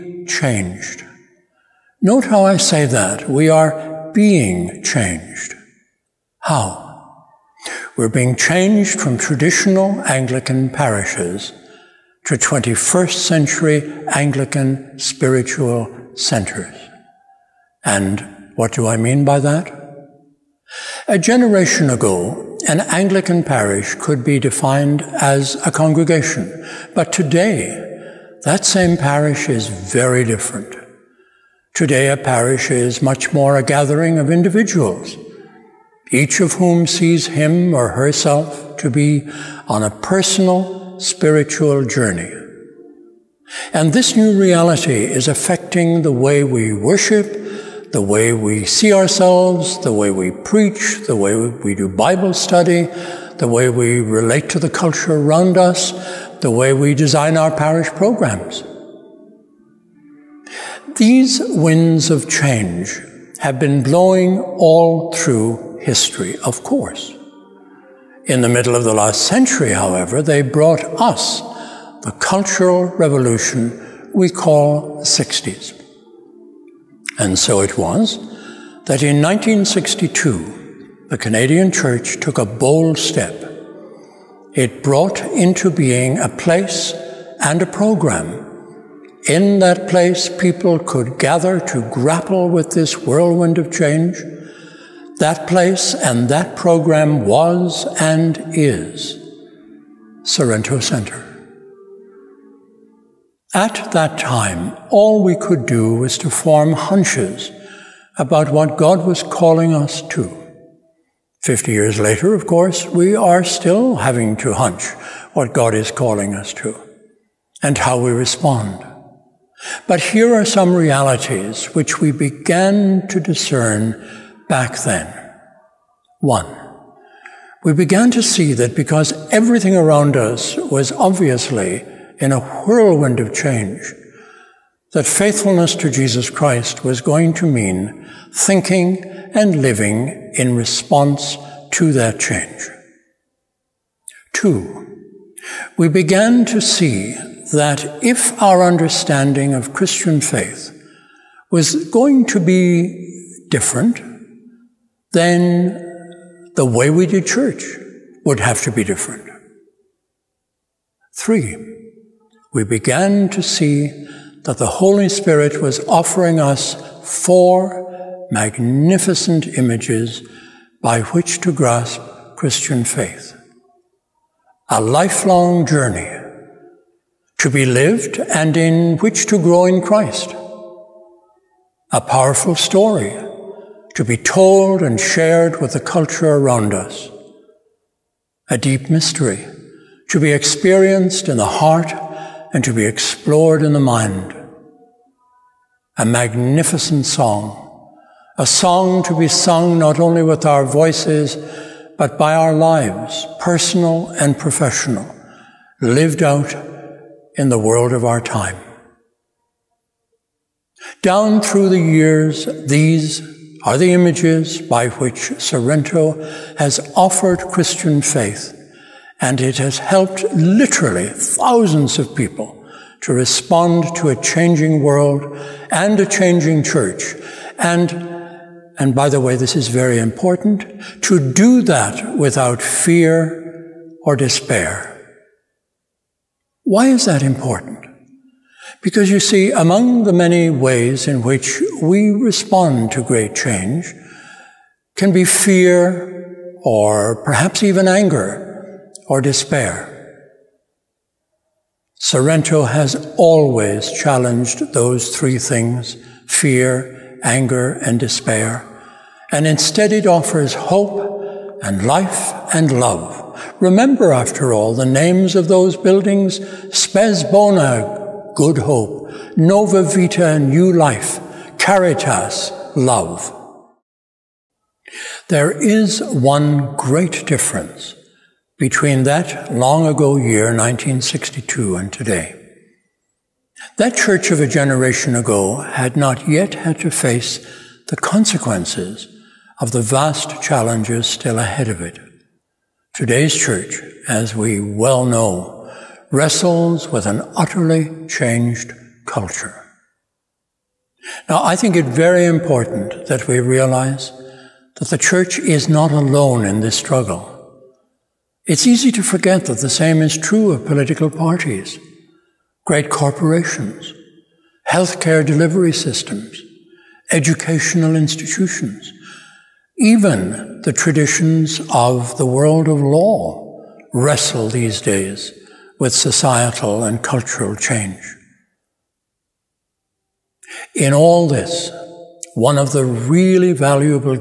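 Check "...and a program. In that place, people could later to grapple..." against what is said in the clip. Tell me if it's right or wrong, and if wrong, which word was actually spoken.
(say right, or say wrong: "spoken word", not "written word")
wrong: "gather", not "later".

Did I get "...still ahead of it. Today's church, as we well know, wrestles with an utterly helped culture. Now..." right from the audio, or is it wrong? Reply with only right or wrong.
wrong.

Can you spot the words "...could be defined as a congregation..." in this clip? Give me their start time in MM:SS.
00:23.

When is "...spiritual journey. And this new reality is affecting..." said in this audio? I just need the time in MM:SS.
00:40.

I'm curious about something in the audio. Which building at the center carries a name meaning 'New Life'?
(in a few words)
Nova Vita.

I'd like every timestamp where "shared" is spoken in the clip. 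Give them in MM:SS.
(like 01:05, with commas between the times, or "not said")
03:04.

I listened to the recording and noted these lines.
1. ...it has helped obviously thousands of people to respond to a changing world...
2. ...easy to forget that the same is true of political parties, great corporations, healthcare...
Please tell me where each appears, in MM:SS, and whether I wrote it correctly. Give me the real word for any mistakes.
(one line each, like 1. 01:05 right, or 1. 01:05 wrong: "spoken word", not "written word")
1. 03:39 wrong: "literally", not "obviously"
2. 05:08 right.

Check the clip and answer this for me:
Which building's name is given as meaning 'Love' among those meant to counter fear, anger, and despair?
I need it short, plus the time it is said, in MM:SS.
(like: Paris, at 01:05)
Caritas, at 04:31.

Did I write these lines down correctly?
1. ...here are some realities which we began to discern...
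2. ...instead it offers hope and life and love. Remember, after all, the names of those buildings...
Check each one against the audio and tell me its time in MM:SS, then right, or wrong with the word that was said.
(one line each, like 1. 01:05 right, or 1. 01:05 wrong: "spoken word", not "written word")
1. 02:00 right
2. 04:19 right.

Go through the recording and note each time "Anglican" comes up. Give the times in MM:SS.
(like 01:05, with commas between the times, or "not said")
00:10, 00:14, 00:22.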